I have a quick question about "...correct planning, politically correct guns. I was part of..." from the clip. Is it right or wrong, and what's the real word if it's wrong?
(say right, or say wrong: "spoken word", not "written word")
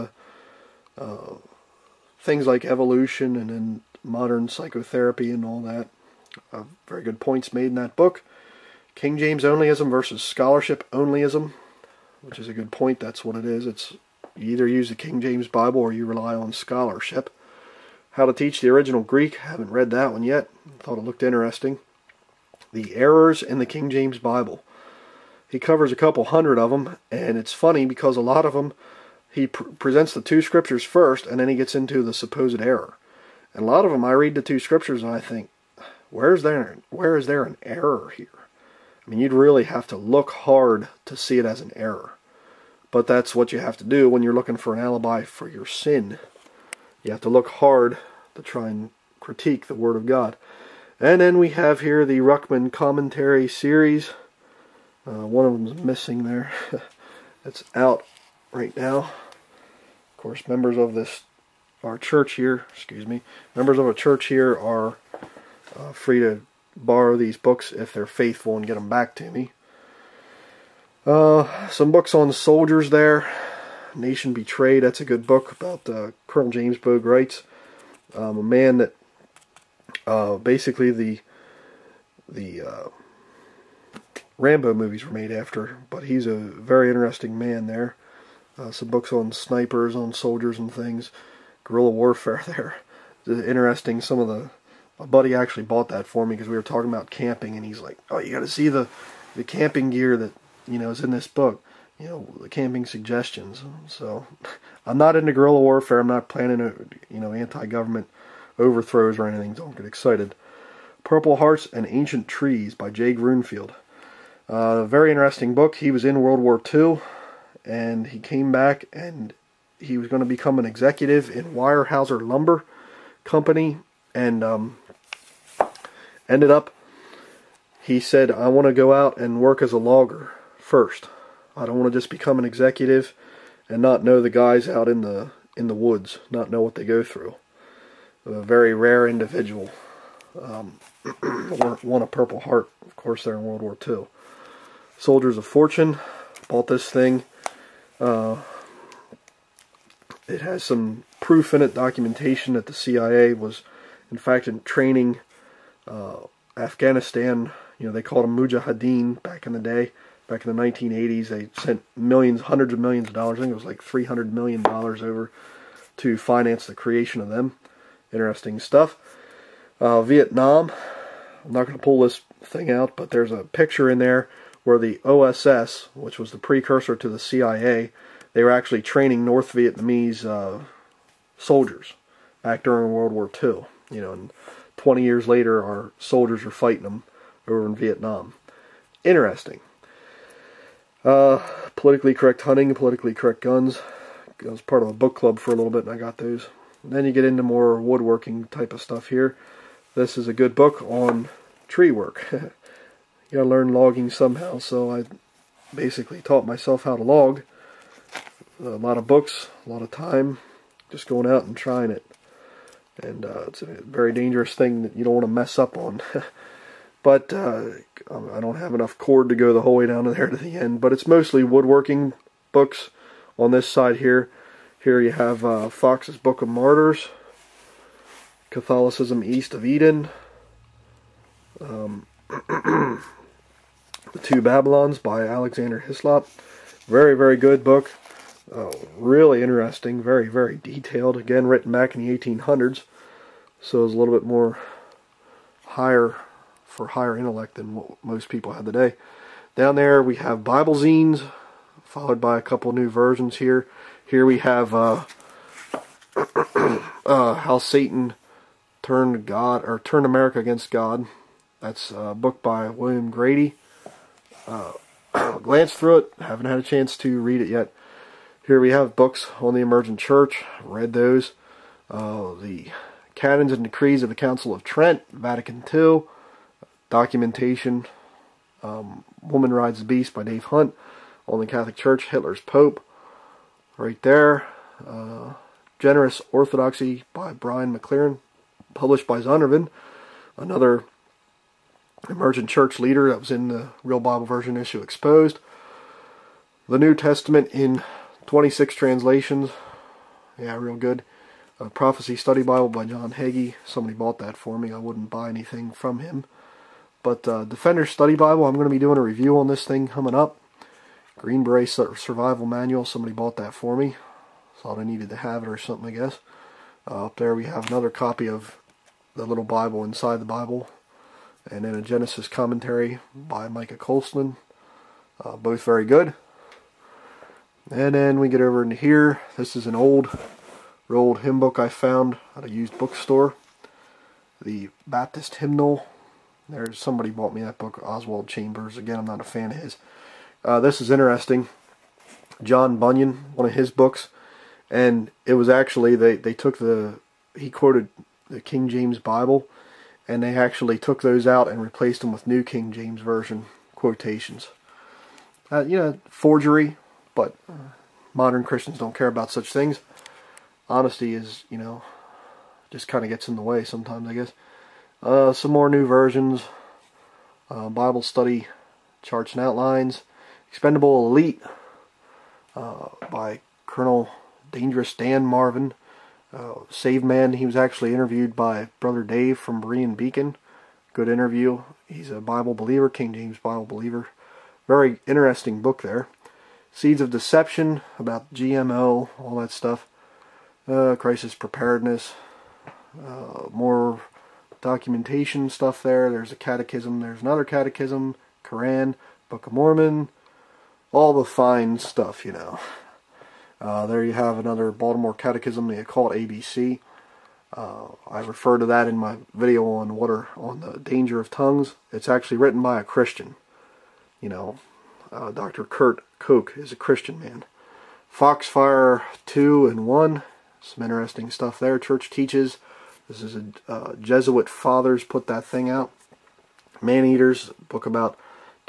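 wrong: "hunting", not "planning".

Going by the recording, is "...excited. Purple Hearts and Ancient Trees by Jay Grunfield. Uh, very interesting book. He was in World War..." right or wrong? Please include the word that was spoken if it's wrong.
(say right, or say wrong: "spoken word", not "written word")
right.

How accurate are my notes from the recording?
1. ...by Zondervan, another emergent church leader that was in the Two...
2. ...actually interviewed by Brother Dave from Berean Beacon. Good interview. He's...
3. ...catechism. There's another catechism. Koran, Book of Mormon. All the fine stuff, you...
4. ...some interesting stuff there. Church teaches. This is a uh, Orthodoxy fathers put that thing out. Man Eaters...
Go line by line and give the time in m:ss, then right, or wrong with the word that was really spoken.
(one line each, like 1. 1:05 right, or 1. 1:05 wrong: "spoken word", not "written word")
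1. 4:49 wrong: "Real", not "Two"
2. 6:17 right
3. 6:36 right
4. 7:00 wrong: "Jesuit", not "Orthodoxy".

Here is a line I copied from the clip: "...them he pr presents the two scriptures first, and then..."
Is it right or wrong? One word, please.
right.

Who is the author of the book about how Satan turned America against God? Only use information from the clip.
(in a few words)
William Grady.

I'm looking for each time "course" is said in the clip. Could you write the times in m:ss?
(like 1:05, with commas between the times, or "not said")
1:00, 2:22.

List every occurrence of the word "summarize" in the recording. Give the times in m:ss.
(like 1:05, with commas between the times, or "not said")
not said.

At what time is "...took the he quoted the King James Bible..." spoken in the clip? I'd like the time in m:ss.
5:46.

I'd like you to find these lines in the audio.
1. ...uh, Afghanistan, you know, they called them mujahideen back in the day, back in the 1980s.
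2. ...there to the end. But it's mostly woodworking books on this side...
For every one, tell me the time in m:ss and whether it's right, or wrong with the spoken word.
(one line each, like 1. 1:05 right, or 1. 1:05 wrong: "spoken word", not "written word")
1. 2:35 right
2. 3:40 right.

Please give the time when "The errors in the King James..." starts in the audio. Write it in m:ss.
0:22.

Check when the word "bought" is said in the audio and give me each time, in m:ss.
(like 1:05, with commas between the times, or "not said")
1:35, 2:26, 5:03, 5:13, 5:37.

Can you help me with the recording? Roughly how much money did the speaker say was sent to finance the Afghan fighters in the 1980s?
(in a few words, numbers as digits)
300 million dollars.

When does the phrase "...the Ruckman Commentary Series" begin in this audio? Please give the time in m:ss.
0:52.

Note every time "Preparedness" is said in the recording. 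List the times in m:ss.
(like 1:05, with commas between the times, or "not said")
6:31.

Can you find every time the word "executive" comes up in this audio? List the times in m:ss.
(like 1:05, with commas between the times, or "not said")
2:00, 2:12.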